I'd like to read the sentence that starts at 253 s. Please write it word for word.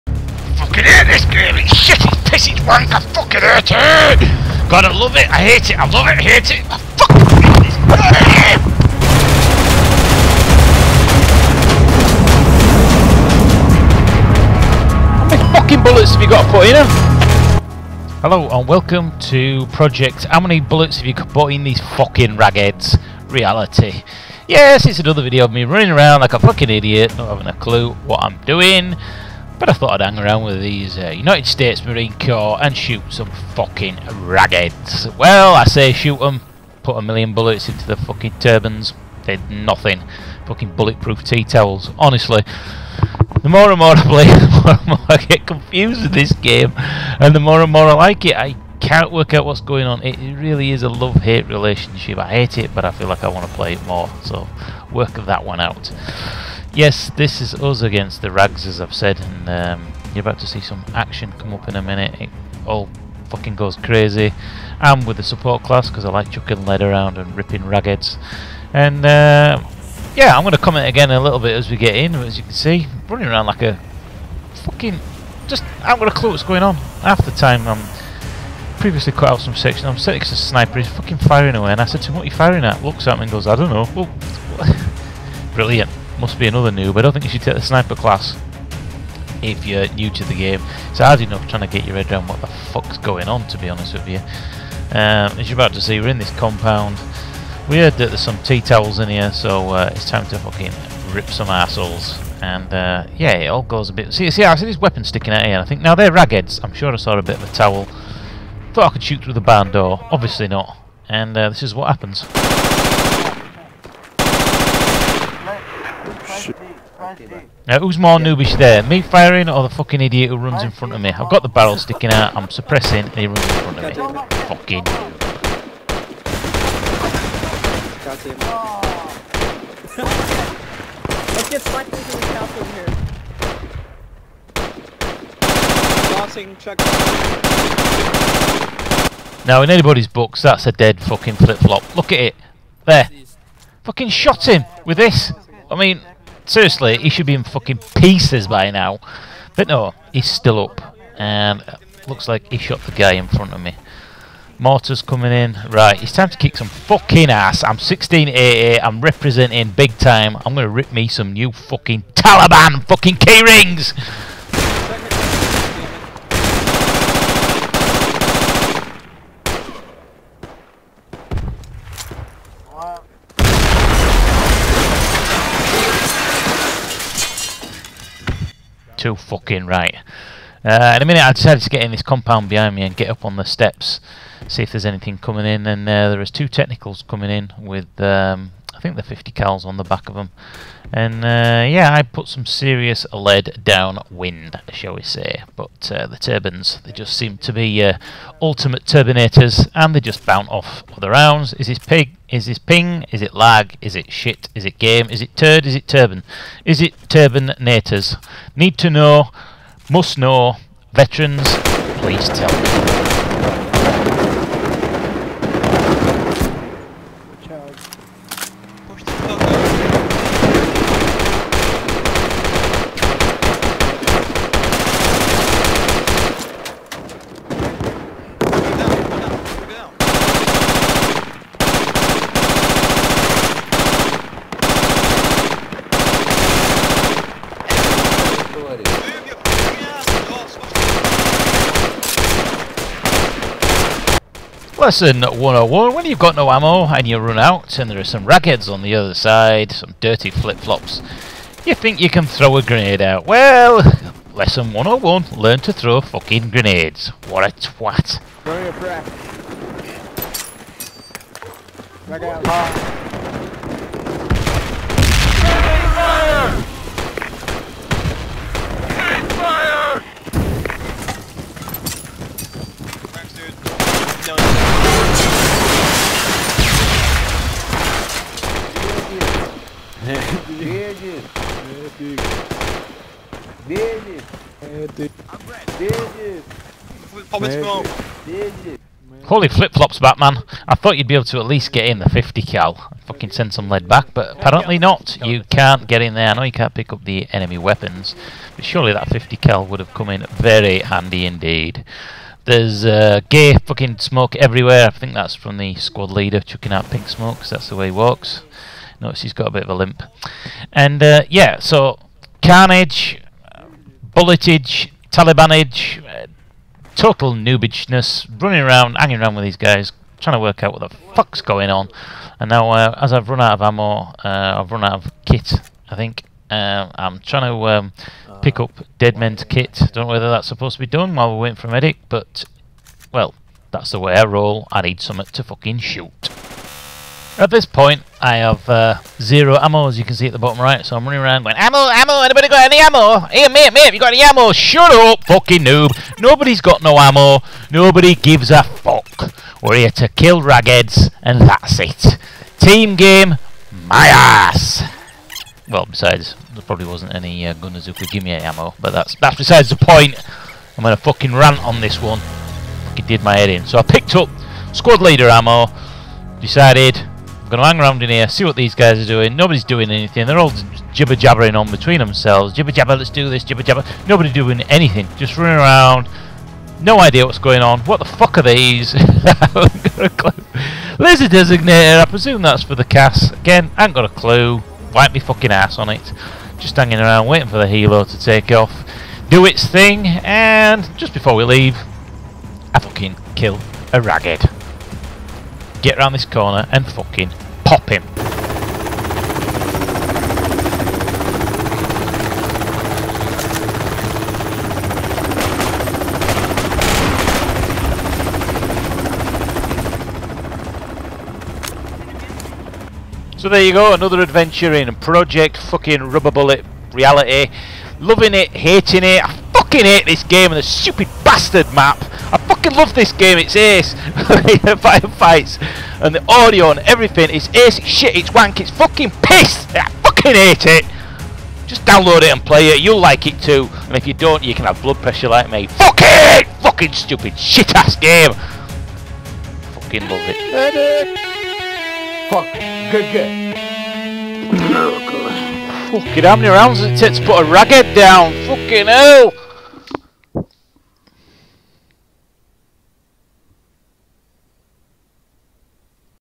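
Well, lesson 101, learn to throw fucking grenades.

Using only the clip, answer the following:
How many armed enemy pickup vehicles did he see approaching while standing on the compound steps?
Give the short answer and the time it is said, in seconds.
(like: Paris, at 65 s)
2, at 186 s.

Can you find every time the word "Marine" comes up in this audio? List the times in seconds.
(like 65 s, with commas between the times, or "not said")
31 s.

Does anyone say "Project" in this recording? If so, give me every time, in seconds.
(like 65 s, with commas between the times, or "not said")
19 s, 414 s.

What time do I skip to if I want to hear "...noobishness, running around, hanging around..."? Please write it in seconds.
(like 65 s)
317 s.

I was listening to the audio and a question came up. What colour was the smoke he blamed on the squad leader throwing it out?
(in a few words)
Pink.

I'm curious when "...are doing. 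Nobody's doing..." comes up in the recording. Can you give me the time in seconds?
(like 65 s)
368 s.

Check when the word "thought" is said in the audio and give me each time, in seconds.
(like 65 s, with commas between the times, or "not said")
29 s, 108 s, 290 s.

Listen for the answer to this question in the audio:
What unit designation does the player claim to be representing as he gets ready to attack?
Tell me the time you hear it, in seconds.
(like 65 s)
157 s.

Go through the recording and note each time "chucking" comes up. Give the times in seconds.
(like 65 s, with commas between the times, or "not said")
66 s, 306 s.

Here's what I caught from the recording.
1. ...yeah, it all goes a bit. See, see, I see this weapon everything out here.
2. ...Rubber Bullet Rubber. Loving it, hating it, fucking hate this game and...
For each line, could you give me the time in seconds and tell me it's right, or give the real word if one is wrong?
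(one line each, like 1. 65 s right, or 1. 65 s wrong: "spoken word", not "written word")
1. 103 s wrong: "sticking", not "everything"
2. 416 s wrong: "Reality", not "Rubber".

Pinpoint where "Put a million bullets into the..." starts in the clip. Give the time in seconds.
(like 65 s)
36 s.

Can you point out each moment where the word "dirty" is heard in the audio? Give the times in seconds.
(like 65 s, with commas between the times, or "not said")
249 s.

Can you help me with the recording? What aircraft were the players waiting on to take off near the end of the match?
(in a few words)
Helo.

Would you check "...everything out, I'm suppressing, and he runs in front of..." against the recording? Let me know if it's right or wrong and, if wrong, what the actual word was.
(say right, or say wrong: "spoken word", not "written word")
wrong: "sticking", not "everything".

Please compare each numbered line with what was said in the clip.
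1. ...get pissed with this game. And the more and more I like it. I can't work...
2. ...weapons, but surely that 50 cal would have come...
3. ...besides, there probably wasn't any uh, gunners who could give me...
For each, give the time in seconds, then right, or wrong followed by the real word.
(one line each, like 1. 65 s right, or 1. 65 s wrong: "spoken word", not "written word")
1. 45 s wrong: "confused", not "pissed"
2. 297 s right
3. 355 s right.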